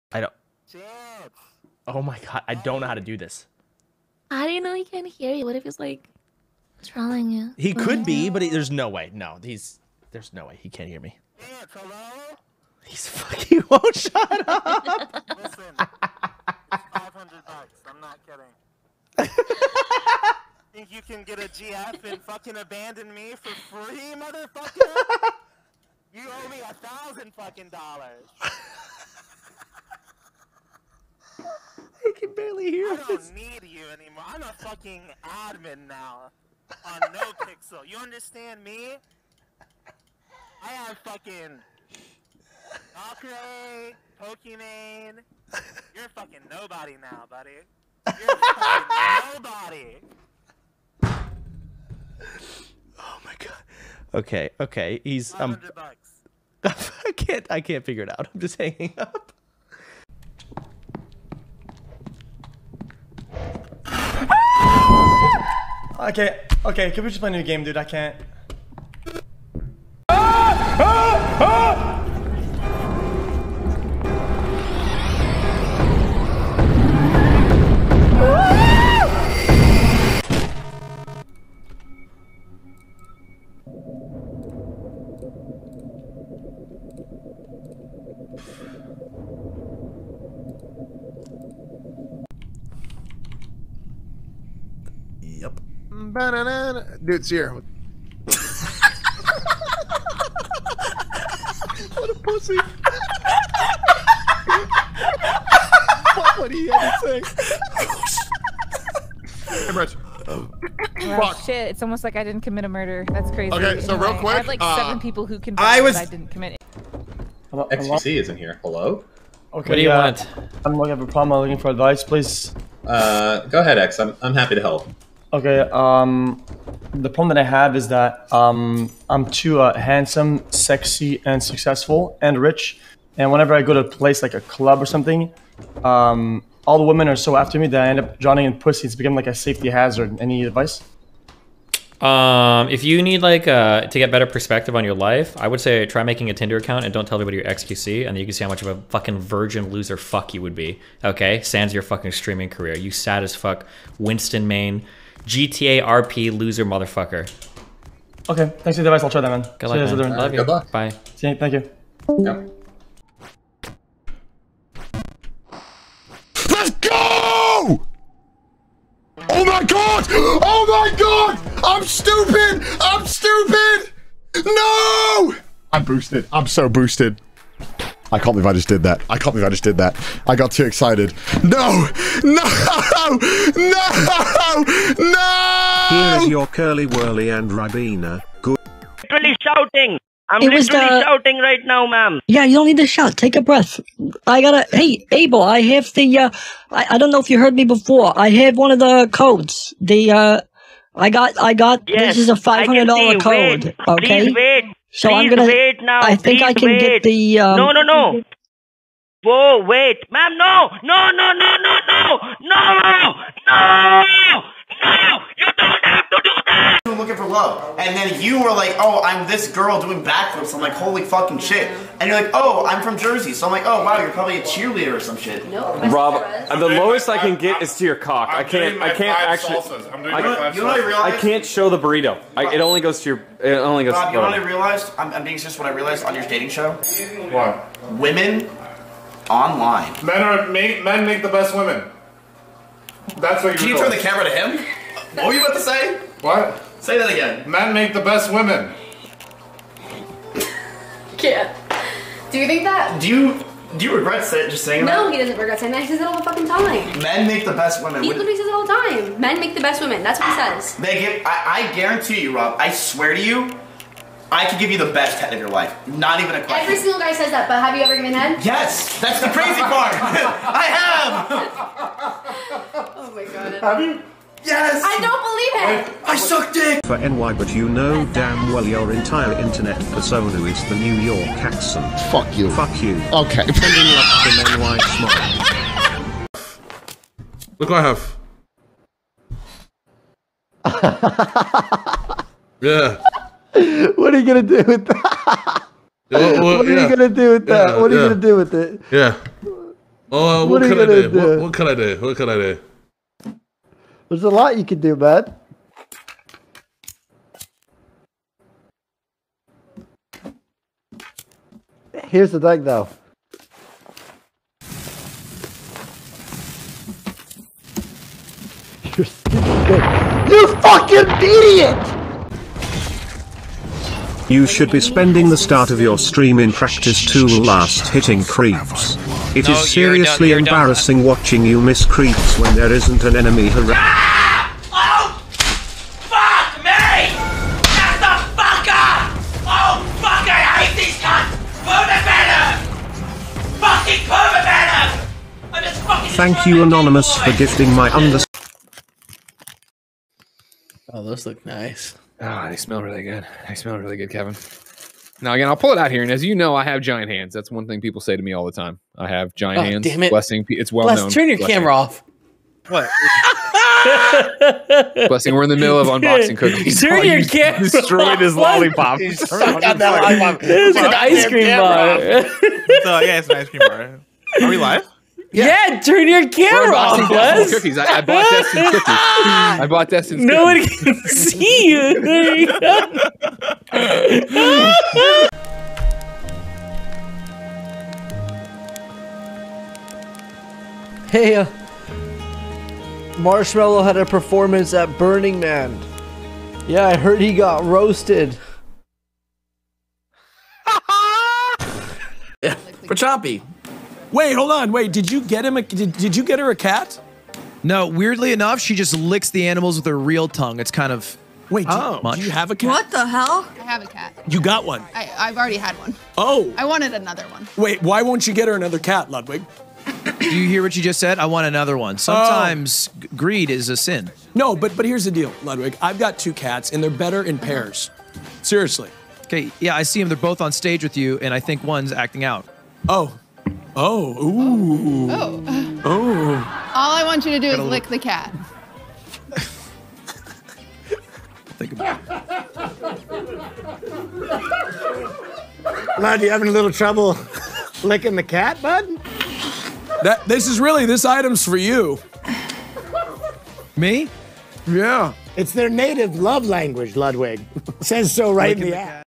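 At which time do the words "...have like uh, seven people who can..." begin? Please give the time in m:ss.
1:54.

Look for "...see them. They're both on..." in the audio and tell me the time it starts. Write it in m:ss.
7:09.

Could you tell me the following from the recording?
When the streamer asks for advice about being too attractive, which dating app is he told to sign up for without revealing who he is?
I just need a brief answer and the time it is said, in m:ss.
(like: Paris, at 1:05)
Tinder, at 2:26.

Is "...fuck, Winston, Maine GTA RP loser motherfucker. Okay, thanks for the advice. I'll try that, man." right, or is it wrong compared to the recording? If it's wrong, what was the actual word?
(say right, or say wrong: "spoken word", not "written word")
right.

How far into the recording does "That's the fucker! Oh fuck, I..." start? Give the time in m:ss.
5:37.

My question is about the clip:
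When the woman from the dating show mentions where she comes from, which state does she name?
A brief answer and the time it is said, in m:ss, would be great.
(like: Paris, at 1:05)
Jersey, at 3:42.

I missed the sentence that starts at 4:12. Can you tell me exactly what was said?
Do you do you regret say, just saying no, that?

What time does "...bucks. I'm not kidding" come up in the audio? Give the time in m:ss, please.
0:17.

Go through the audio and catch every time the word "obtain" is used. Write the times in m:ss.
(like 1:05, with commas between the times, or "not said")
not said.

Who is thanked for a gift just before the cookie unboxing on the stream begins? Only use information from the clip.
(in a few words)
Anonymous.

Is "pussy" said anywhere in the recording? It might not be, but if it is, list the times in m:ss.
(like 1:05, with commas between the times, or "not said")
1:42, 2:18.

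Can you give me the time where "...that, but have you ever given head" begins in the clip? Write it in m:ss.
4:27.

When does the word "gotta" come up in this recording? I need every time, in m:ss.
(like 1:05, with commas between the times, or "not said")
3:14, 7:17.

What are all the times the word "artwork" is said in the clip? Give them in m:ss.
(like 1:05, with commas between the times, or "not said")
not said.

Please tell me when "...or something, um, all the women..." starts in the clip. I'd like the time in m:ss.
2:14.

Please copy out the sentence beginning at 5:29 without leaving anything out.
It no, is seriously done, embarrassing done.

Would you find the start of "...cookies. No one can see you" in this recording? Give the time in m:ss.
6:20.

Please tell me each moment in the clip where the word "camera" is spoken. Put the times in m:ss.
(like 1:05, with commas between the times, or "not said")
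4:03, 6:01, 6:07, 6:16.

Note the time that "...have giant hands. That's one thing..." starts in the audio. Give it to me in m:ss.
5:56.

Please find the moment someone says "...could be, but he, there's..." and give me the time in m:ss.
0:07.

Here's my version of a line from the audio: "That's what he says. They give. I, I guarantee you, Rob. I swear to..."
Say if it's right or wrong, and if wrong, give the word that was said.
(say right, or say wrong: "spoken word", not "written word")
right.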